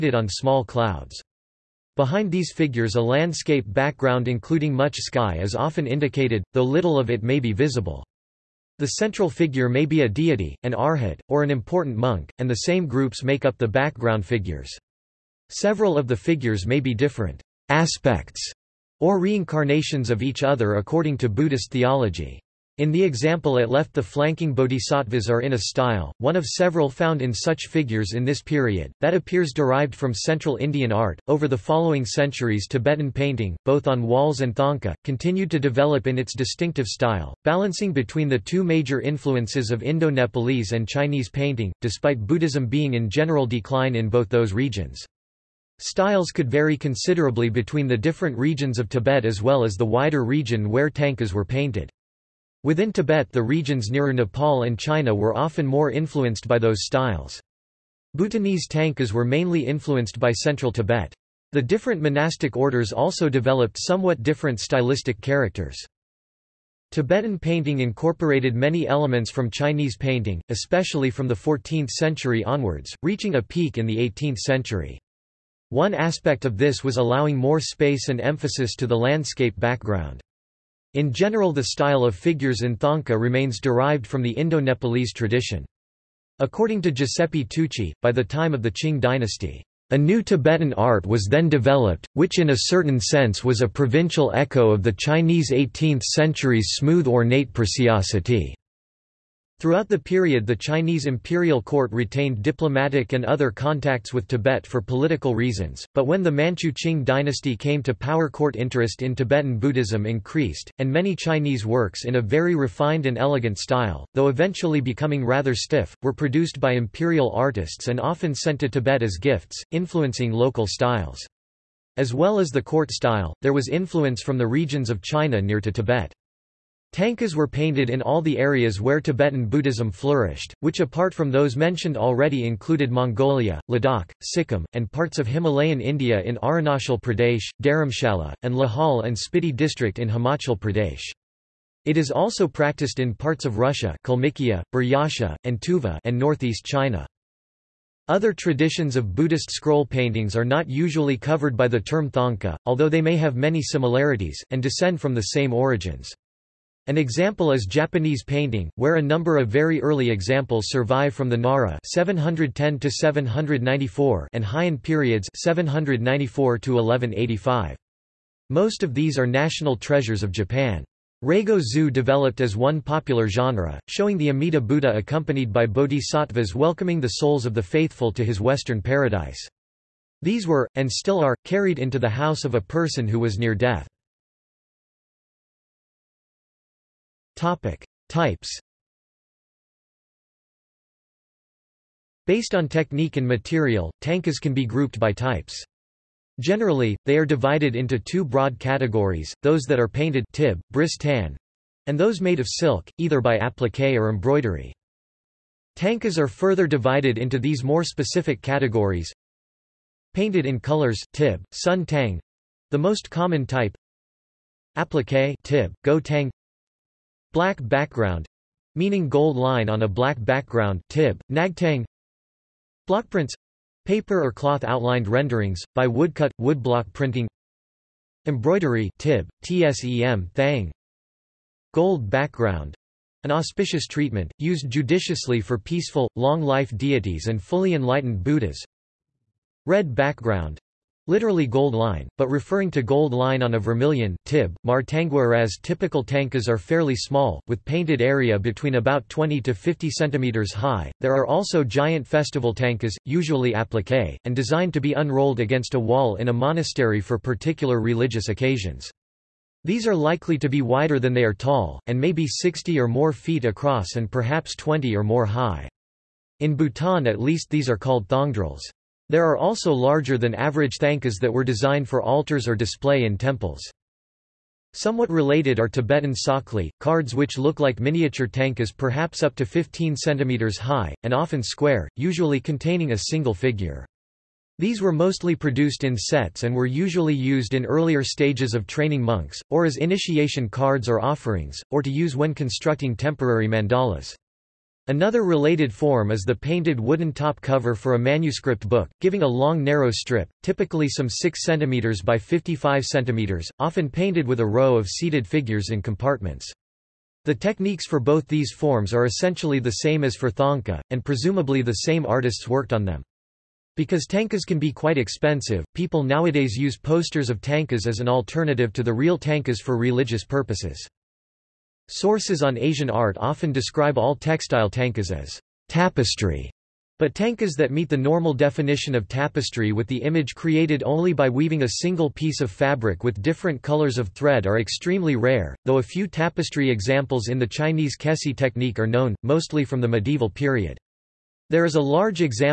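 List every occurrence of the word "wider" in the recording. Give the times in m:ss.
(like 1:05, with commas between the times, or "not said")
0:49, 4:20.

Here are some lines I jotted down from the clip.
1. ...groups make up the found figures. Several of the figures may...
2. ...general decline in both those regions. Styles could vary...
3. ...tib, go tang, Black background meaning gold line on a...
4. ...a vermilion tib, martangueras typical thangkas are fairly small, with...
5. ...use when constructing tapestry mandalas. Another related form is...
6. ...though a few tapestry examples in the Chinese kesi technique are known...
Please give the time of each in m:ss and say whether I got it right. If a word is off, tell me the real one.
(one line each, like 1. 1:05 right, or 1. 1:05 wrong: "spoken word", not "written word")
1. 0:12 wrong: "background", not "found"
2. 0:43 right
3. 3:35 right
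4. 4:03 right
5. 4:51 wrong: "temporary", not "tapestry"
6. 5:35 right.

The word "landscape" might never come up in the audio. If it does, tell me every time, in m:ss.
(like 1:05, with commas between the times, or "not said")
0:03, 1:18.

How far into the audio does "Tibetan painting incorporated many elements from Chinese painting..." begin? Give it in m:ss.
1:06.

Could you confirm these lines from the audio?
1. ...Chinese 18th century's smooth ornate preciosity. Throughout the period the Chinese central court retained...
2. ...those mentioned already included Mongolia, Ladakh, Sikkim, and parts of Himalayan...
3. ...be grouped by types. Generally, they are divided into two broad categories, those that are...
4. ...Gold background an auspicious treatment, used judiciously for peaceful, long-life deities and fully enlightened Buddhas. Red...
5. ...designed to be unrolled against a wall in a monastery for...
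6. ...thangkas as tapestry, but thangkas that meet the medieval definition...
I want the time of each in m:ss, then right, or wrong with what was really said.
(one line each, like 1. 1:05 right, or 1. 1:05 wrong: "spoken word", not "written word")
1. 1:34 wrong: "imperial", not "central"
2. 2:11 right
3. 3:14 right
4. 3:51 right
5. 4:14 right
6. 5:24 wrong: "normal", not "medieval".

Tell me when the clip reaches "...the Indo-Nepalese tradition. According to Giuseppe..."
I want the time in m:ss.
1:24.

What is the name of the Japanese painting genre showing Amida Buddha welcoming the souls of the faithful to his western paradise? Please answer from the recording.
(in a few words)
Reigo Zu.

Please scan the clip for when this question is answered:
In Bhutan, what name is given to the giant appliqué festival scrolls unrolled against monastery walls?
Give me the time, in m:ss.
4:28.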